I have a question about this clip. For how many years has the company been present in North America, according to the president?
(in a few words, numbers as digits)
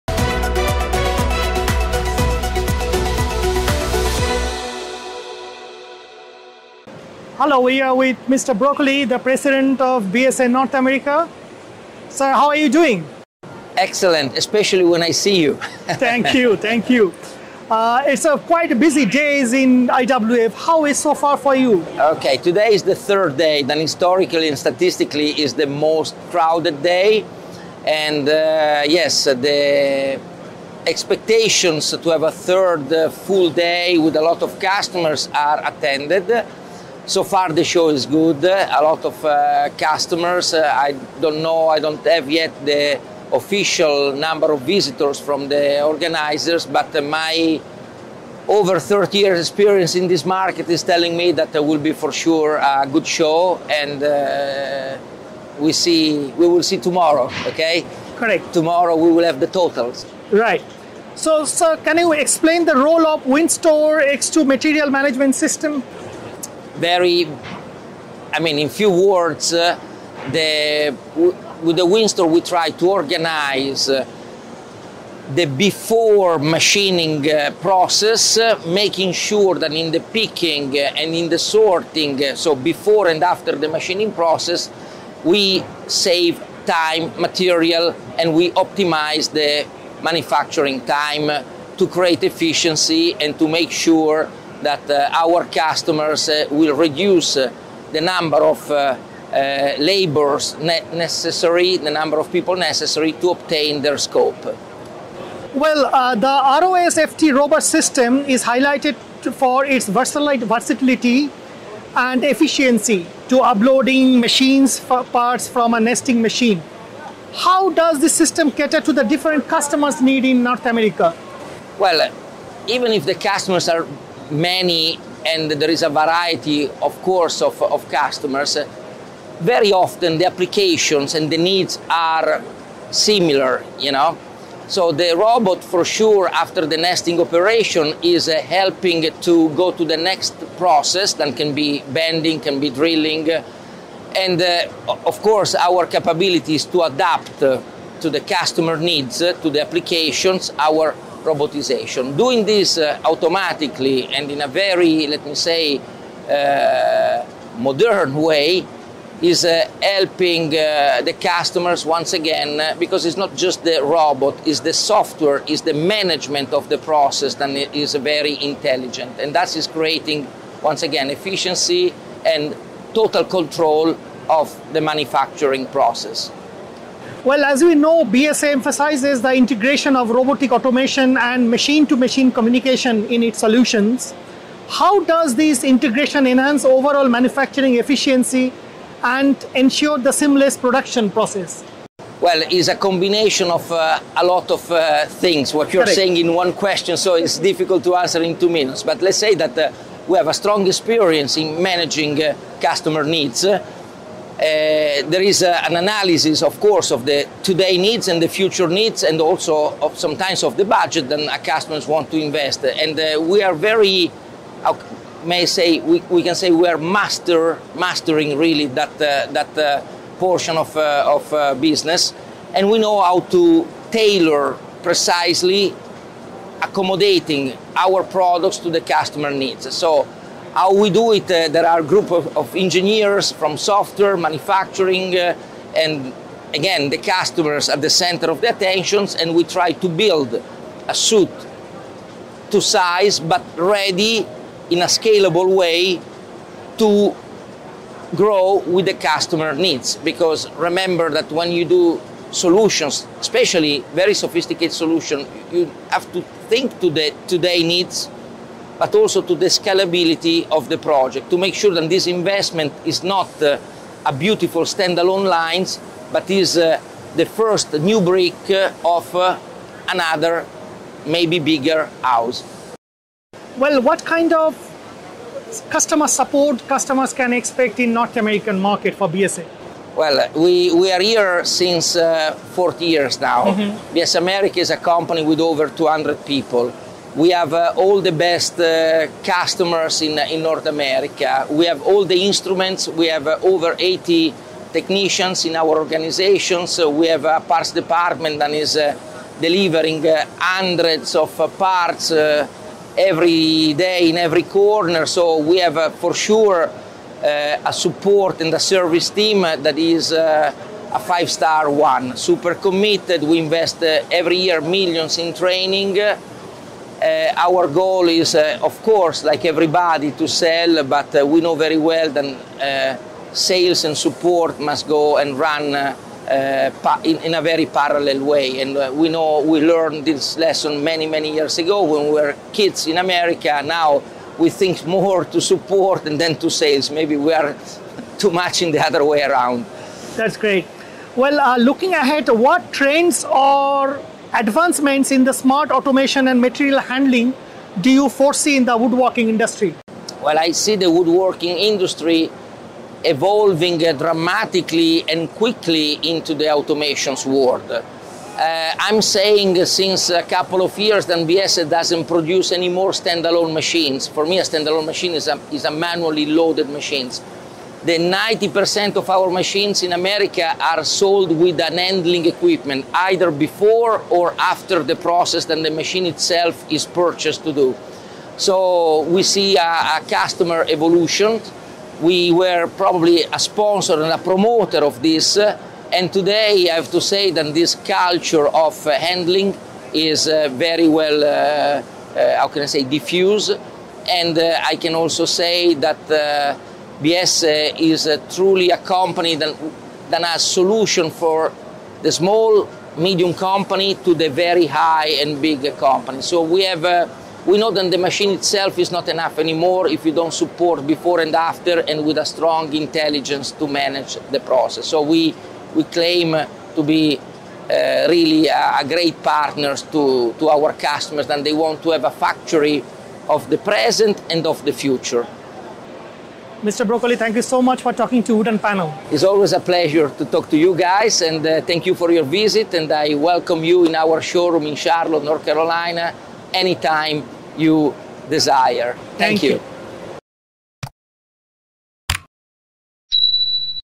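40 years.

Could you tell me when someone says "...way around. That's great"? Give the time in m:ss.
5:39.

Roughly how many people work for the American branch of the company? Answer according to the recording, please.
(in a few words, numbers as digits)
Over 200.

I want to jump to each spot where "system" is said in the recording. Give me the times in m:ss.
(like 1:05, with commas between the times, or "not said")
1:05, 1:47, 1:58.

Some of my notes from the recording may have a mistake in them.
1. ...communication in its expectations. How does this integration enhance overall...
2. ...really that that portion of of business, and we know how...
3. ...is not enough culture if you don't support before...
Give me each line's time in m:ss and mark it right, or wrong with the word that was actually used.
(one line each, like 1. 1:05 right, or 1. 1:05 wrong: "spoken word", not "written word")
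1. 3:02 wrong: "solutions", not "expectations"
2. 3:38 right
3. 6:48 wrong: "anymore", not "culture".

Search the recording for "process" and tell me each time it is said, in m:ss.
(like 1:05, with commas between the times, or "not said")
1:17, 1:24, 2:20, 2:46, 2:55, 3:11, 6:14, 6:54.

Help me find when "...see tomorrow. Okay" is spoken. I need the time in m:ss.
0:56.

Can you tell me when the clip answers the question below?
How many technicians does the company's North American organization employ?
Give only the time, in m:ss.
4:53.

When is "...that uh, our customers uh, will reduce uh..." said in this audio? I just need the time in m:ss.
1:34.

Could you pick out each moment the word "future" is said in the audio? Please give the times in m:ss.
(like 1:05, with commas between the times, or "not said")
3:28, 7:04.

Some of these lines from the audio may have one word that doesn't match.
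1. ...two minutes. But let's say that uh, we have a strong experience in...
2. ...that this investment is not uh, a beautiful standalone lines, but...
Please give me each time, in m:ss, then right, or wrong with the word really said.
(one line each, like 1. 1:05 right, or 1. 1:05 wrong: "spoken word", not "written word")
1. 3:18 right
2. 4:21 right.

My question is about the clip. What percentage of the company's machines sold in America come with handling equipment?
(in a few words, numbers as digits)
90%.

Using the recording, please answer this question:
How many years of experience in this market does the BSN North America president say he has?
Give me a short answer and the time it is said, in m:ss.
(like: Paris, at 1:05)
Over 30 years, at 0:48.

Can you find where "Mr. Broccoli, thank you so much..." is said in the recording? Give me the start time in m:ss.
7:06.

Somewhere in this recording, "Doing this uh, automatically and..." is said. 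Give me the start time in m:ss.
2:32.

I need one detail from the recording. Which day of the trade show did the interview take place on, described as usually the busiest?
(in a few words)
Third day.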